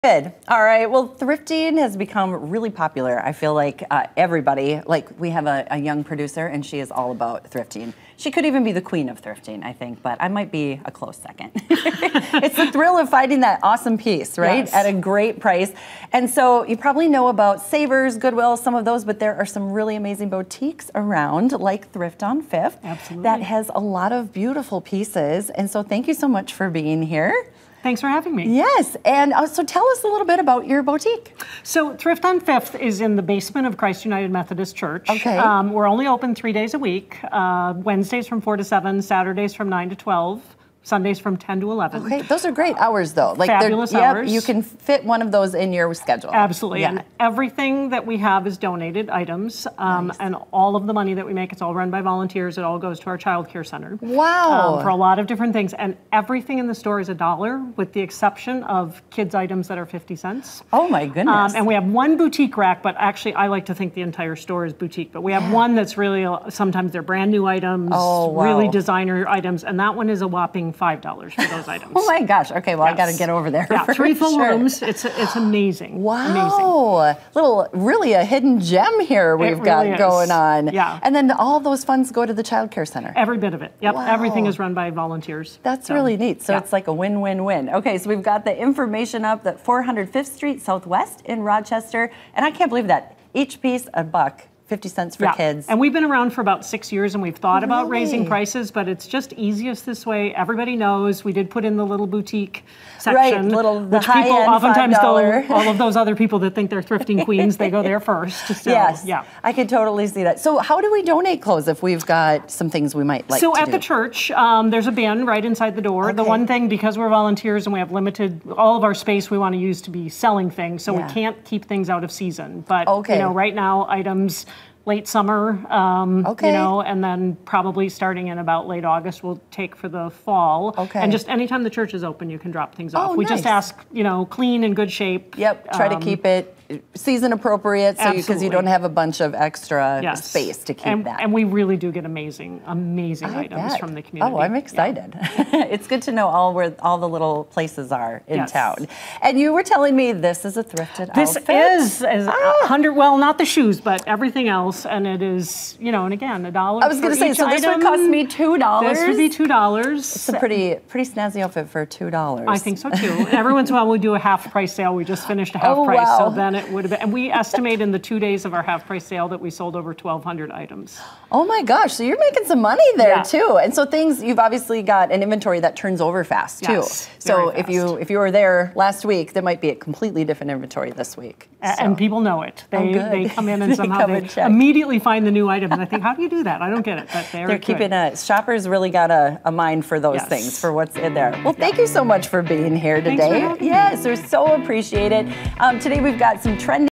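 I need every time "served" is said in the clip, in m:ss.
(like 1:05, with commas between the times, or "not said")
not said.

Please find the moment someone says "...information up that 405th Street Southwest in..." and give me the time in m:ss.
1:28.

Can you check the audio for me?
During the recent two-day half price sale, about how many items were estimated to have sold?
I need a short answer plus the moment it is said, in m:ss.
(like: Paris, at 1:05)
over 1,200, at 2:49.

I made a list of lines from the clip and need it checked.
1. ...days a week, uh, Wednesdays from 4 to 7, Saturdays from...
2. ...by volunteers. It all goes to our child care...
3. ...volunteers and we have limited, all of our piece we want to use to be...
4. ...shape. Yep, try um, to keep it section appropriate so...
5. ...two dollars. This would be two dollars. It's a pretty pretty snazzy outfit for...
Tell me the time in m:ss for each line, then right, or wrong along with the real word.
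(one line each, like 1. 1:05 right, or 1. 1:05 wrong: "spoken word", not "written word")
1. 0:36 right
2. 0:51 right
3. 1:57 wrong: "space", not "piece"
4. 2:14 wrong: "season", not "section"
5. 2:38 right.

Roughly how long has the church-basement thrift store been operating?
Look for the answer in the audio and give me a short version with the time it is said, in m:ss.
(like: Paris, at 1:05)
about six years, at 1:36.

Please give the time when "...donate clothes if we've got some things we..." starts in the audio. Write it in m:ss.
1:51.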